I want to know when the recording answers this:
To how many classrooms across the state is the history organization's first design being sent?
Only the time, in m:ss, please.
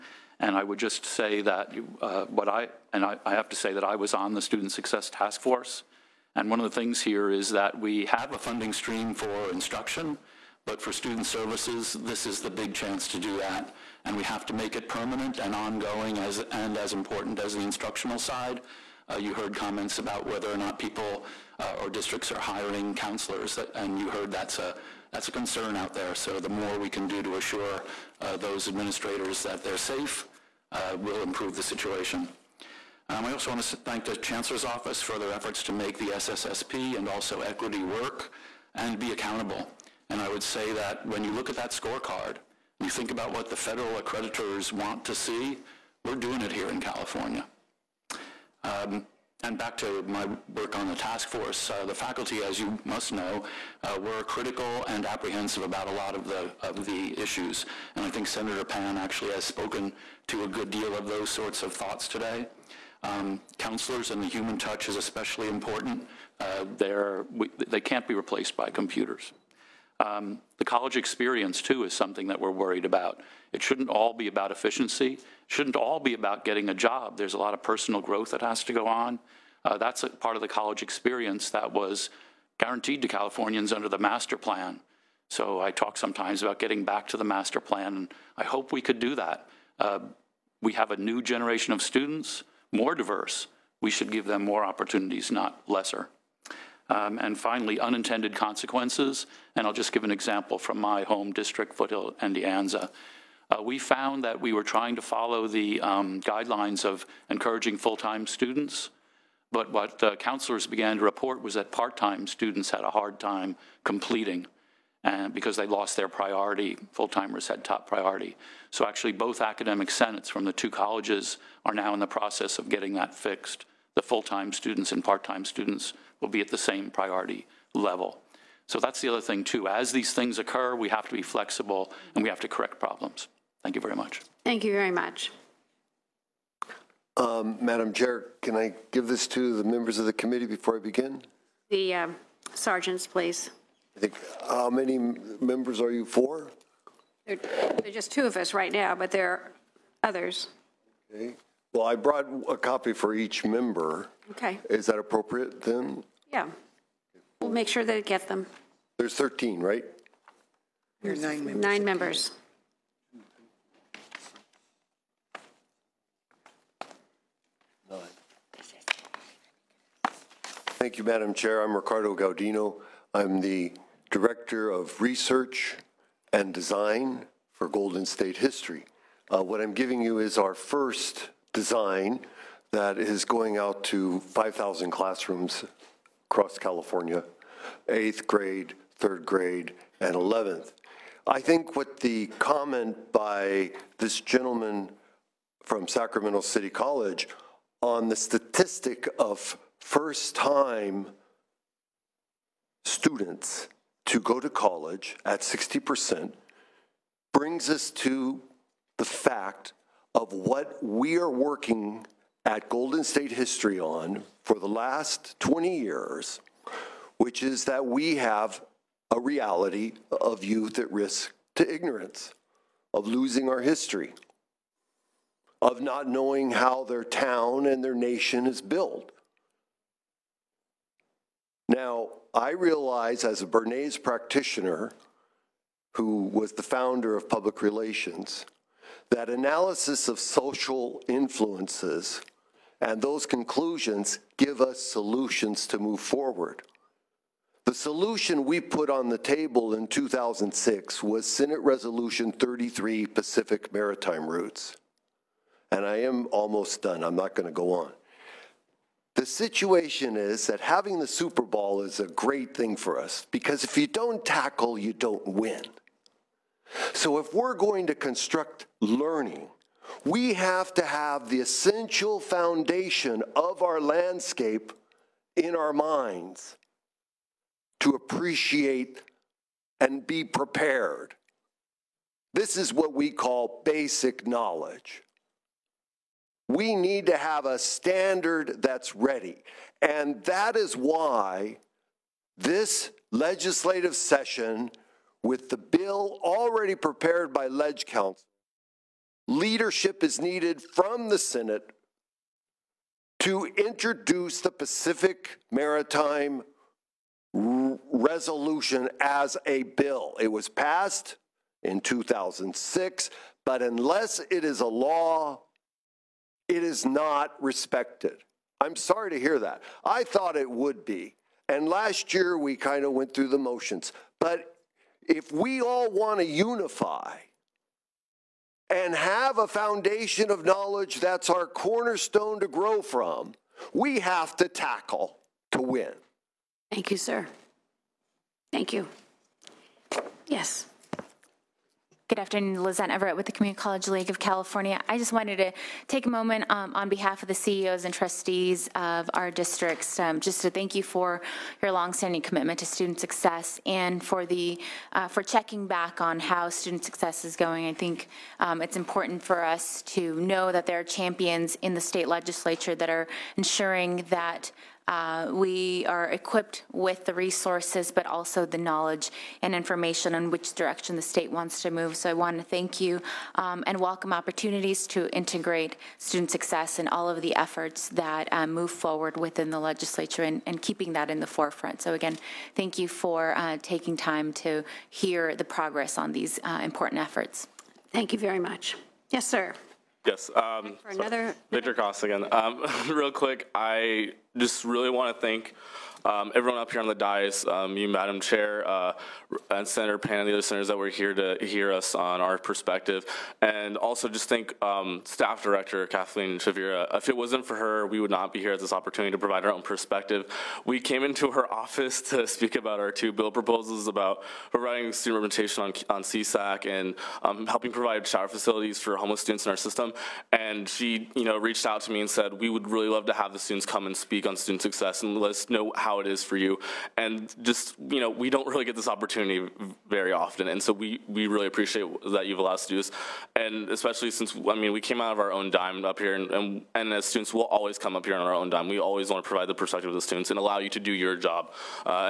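3:04.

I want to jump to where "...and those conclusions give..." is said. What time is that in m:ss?
4:02.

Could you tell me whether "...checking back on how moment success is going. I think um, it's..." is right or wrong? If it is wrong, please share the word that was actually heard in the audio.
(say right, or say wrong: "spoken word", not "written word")
wrong: "student", not "moment".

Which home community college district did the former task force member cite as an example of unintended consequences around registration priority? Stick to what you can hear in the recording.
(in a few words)
Foothill-De Anza.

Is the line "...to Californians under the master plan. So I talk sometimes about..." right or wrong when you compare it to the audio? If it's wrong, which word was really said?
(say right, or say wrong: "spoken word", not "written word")
right.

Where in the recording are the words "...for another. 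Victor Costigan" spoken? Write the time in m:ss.
6:30.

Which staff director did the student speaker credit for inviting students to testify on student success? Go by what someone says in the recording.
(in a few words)
Kathleen Chavira.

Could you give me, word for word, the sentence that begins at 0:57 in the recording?
And I think Senator Pan actually has spoken to a good deal of those sorts of thoughts today.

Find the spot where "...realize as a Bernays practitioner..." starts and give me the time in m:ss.
3:52.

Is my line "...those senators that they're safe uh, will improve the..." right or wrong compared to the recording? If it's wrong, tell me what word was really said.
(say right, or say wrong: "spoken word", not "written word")
wrong: "administrators", not "senators".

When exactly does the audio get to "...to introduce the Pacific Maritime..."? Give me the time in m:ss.
5:03.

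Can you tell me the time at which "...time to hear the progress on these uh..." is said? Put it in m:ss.
6:23.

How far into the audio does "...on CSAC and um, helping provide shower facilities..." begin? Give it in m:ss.
6:55.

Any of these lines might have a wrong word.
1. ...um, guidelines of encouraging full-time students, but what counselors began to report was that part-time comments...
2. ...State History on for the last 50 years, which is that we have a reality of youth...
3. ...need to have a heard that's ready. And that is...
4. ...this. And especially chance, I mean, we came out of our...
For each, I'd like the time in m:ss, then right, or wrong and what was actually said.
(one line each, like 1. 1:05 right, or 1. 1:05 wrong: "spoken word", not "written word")
1. 1:45 wrong: "students", not "comments"
2. 3:33 wrong: "20", not "50"
3. 4:46 wrong: "standard", not "heard"
4. 7:12 wrong: "since", not "chance".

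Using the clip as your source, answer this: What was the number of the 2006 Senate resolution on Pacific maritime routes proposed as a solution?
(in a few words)
33.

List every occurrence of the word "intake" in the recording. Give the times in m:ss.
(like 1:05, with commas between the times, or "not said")
not said.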